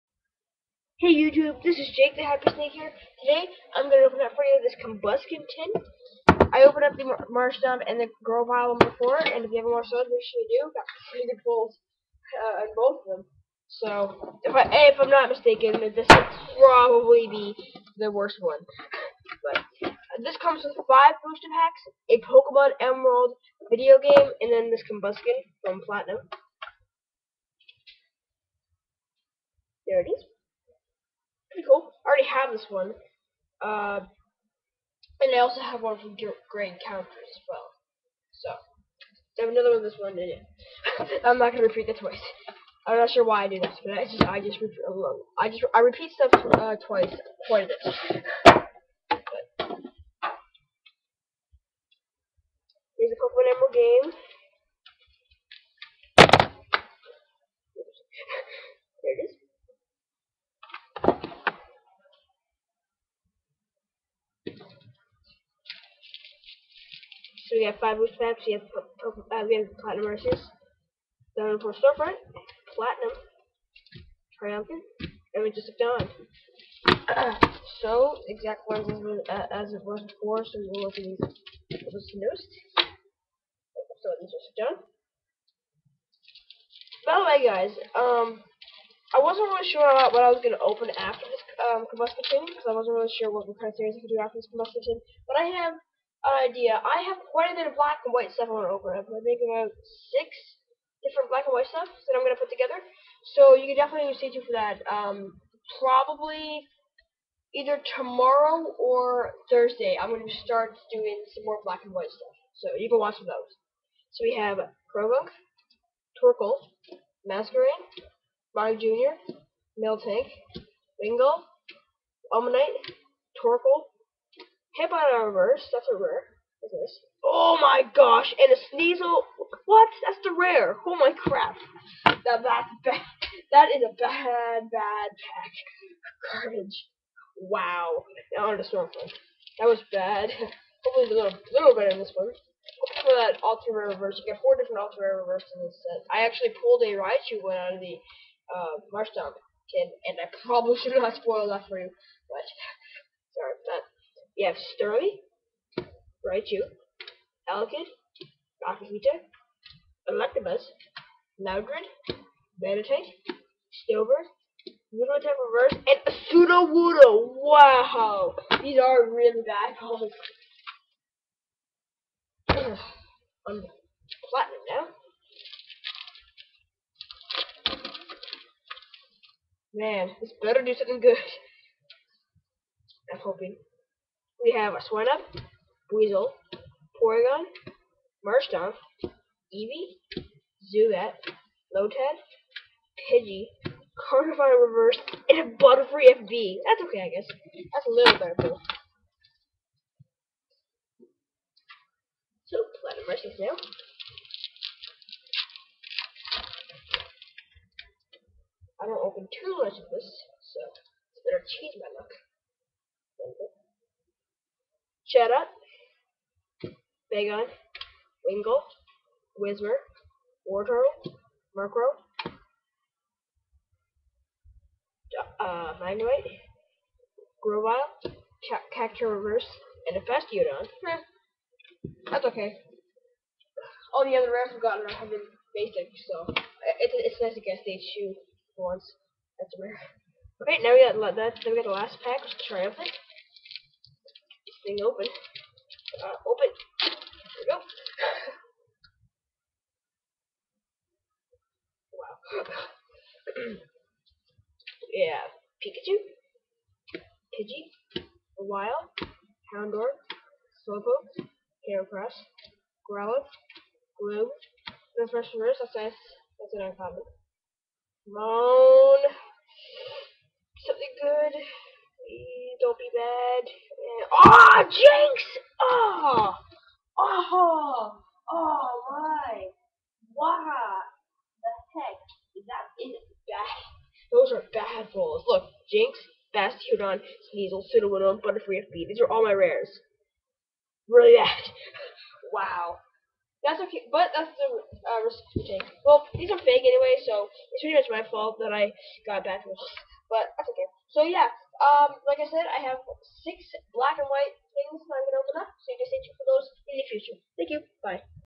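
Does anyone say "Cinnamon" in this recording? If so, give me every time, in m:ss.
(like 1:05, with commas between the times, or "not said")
4:47.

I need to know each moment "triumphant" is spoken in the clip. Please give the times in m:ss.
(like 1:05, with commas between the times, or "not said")
1:14, 4:02.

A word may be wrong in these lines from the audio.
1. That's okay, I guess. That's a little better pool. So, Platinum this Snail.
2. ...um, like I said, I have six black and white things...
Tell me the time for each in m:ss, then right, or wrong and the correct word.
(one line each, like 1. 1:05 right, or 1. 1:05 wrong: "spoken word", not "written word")
1. 3:16 right
2. 5:01 right.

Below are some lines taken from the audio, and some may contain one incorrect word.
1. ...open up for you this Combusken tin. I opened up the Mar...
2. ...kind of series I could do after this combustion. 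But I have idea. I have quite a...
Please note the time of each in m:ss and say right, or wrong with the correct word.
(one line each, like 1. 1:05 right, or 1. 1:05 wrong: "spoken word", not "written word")
1. 0:04 right
2. 1:33 right.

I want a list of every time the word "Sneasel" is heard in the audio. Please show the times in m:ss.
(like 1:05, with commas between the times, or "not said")
2:08, 4:47.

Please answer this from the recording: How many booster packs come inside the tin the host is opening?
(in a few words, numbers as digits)
5.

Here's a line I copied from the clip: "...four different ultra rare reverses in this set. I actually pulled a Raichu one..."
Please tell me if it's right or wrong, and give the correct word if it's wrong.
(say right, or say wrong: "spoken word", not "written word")
right.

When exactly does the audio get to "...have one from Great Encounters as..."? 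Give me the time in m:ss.
0:35.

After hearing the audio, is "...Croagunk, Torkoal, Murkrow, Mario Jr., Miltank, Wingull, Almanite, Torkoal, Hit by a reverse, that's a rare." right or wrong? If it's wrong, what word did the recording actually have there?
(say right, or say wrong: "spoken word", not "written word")
wrong: "Masquerain", not "Murkrow".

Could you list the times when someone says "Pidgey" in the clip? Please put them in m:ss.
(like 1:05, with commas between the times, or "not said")
3:13, 4:16.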